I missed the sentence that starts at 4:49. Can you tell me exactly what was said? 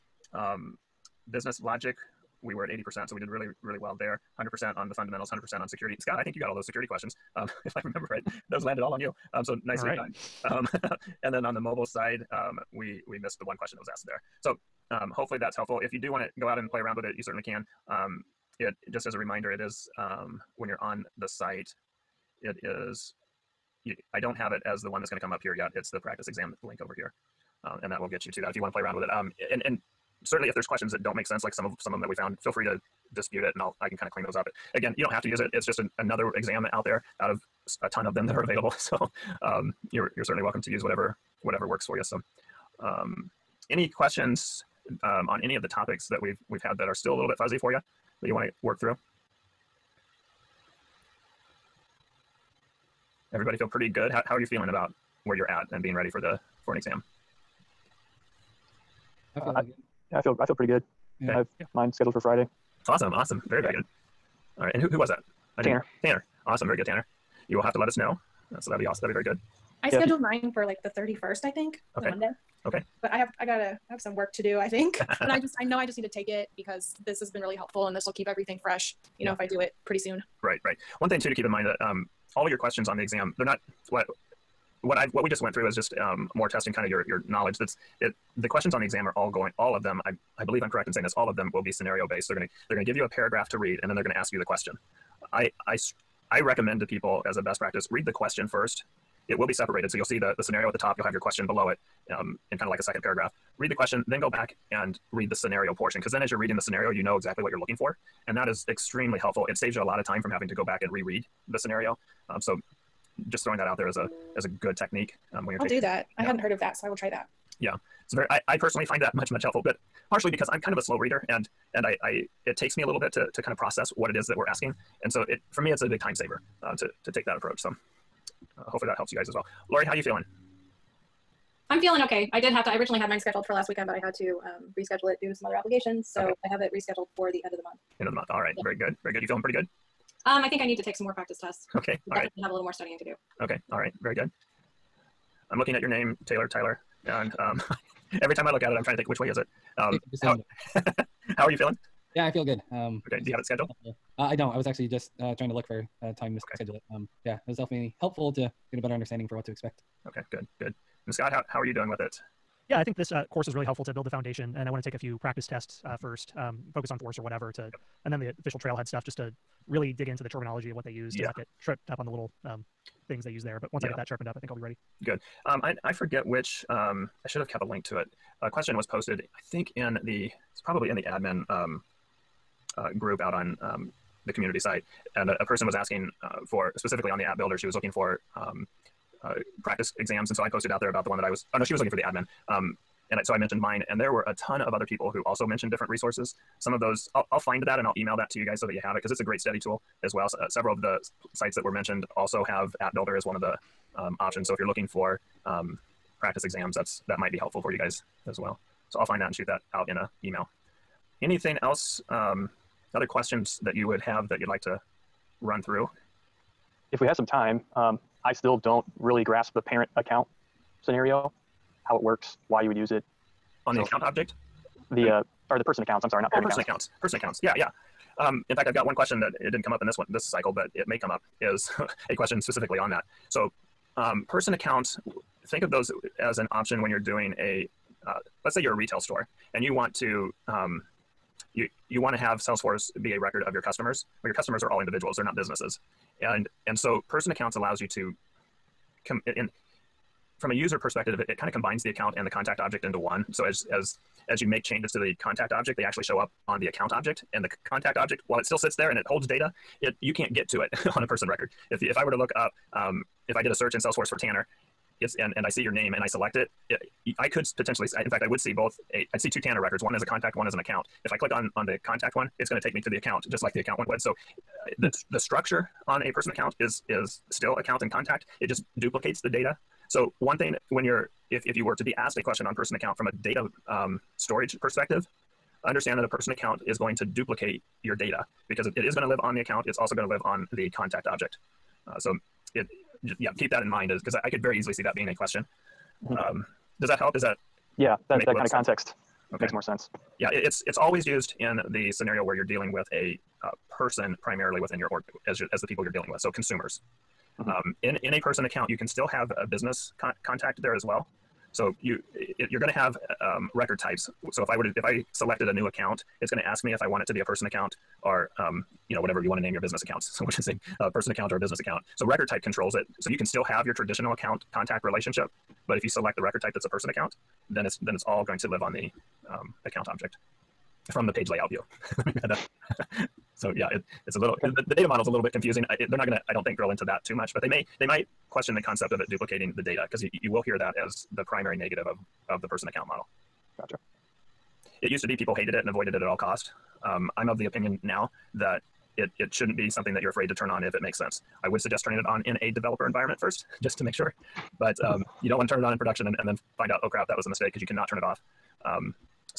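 It's also going to live on the contact object.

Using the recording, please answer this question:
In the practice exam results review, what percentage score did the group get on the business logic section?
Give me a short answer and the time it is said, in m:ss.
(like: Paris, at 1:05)
80%, at 0:02.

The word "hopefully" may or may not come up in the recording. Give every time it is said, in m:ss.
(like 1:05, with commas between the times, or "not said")
0:15, 2:08.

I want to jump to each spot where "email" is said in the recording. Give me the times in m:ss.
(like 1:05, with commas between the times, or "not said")
3:17, 3:30.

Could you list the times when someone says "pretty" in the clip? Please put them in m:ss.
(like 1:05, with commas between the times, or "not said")
0:53, 1:00, 1:19, 2:19.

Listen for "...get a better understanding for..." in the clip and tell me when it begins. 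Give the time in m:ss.
2:38.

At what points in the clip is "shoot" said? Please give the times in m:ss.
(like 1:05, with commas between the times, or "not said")
3:29.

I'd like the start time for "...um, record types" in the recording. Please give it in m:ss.
5:13.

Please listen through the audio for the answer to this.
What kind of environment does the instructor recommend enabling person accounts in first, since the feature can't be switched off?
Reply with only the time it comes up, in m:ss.
5:52.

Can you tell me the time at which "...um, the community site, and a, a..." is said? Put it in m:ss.
3:03.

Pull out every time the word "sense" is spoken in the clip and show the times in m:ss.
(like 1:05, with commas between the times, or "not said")
0:31, 4:59, 5:50.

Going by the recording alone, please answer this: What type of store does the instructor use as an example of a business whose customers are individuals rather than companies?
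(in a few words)
retail store.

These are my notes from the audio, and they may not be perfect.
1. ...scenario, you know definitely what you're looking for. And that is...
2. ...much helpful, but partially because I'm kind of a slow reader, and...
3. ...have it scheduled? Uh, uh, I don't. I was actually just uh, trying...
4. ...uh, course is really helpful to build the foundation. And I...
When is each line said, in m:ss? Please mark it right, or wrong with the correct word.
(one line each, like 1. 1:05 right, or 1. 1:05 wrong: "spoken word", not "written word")
1. 1:46 wrong: "exactly", not "definitely"
2. 1:59 right
3. 2:33 right
4. 2:43 right.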